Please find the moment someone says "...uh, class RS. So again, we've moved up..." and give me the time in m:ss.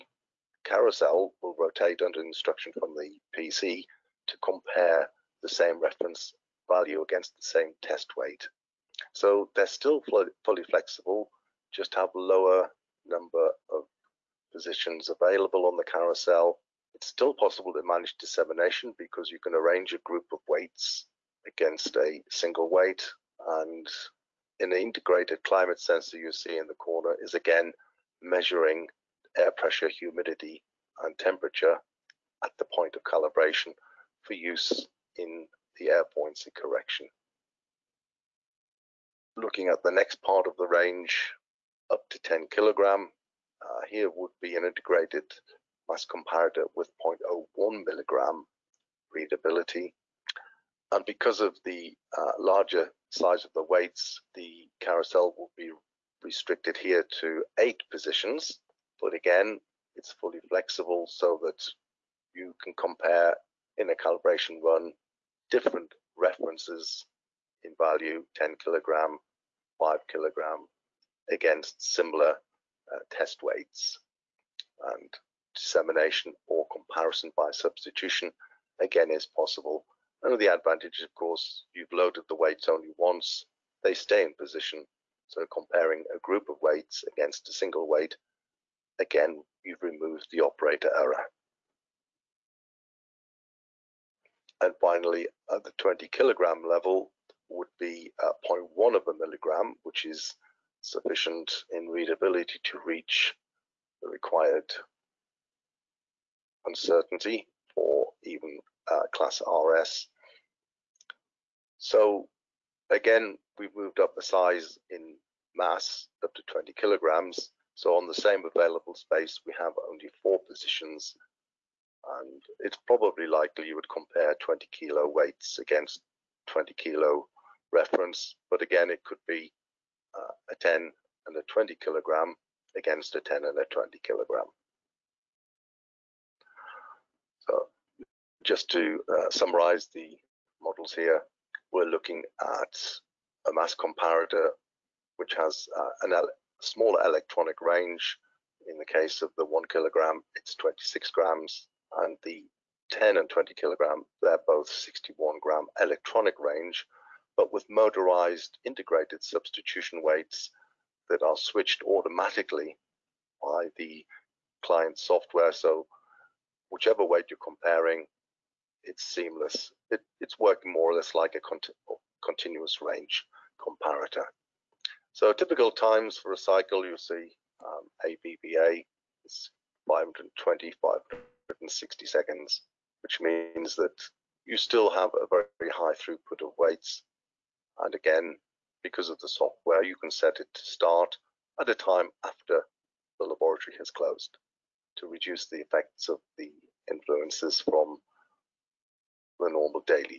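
1:48.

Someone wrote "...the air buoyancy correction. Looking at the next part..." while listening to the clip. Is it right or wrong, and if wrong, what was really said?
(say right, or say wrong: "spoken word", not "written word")
right.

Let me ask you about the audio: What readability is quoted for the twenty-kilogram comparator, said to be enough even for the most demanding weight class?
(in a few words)
0.1 milligram.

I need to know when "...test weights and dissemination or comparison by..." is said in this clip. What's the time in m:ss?
1:13.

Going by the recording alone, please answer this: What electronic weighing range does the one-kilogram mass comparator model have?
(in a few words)
26 grams.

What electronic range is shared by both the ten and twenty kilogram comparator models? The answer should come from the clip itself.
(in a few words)
61 gram.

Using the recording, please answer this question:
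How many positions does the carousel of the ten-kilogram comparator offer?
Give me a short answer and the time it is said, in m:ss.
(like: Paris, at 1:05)
8, at 0:57.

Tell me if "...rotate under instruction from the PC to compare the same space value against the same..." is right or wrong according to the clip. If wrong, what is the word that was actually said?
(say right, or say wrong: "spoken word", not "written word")
wrong: "reference", not "space".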